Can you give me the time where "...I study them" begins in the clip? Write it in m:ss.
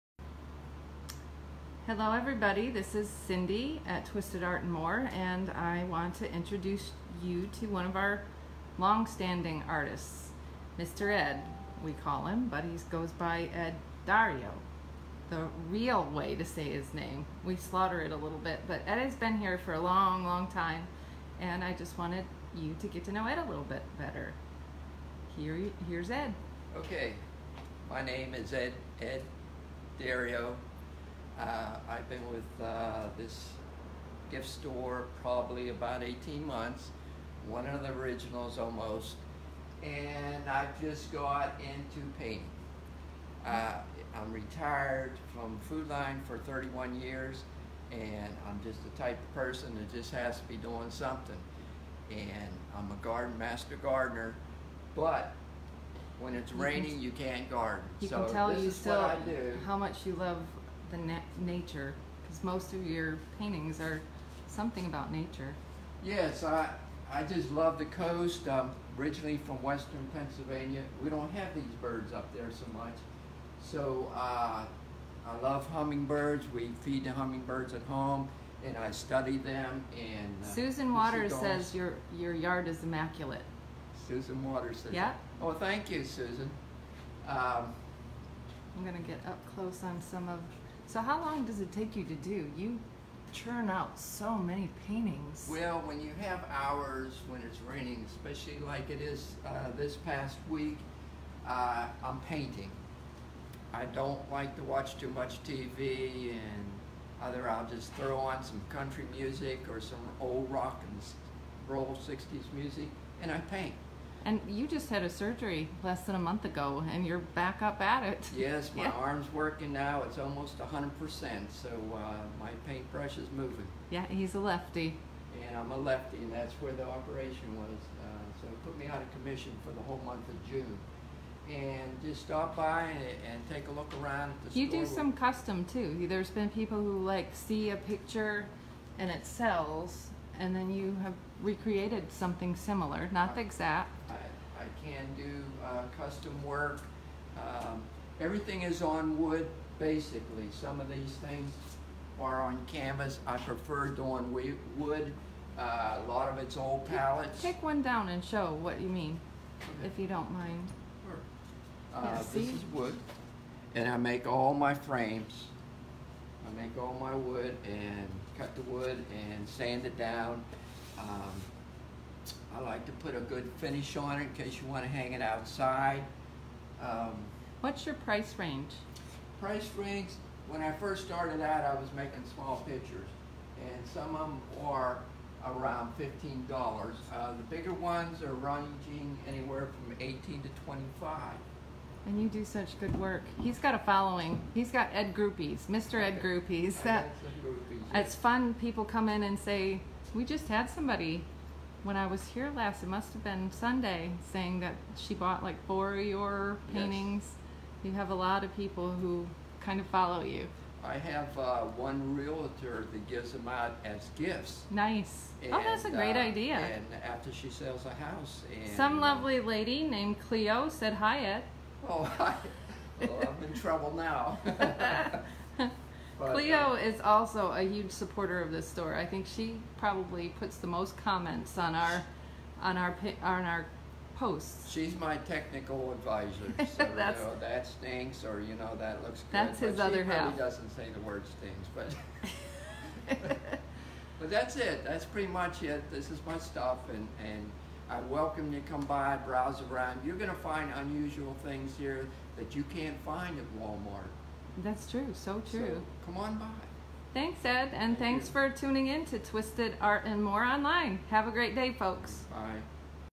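1:18.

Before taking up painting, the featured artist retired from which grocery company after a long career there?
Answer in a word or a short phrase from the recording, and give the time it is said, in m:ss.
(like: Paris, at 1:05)
Food Lion, at 0:45.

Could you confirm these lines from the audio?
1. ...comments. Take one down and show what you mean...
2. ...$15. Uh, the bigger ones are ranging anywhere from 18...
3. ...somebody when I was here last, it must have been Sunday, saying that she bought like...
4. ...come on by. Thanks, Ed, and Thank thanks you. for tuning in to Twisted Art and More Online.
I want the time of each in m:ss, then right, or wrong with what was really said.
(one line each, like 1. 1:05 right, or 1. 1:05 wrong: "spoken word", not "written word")
1. 2:36 wrong: "pallets", not "comments"
2. 3:05 right
3. 3:20 right
4. 4:16 right.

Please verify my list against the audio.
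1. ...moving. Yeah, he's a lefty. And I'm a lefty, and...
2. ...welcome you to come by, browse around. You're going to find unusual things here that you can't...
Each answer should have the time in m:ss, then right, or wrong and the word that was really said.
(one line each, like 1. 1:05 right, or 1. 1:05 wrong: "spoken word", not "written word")
1. 2:03 right
2. 4:08 right.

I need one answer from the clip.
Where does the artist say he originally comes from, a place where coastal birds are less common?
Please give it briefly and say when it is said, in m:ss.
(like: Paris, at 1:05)
Western Pennsylvania, at 1:09.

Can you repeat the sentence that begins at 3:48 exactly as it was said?
I think she probably puts the most comments on our on our on our posts.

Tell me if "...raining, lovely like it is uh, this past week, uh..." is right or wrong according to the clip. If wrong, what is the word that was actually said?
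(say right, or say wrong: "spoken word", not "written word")
wrong: "especially", not "lovely".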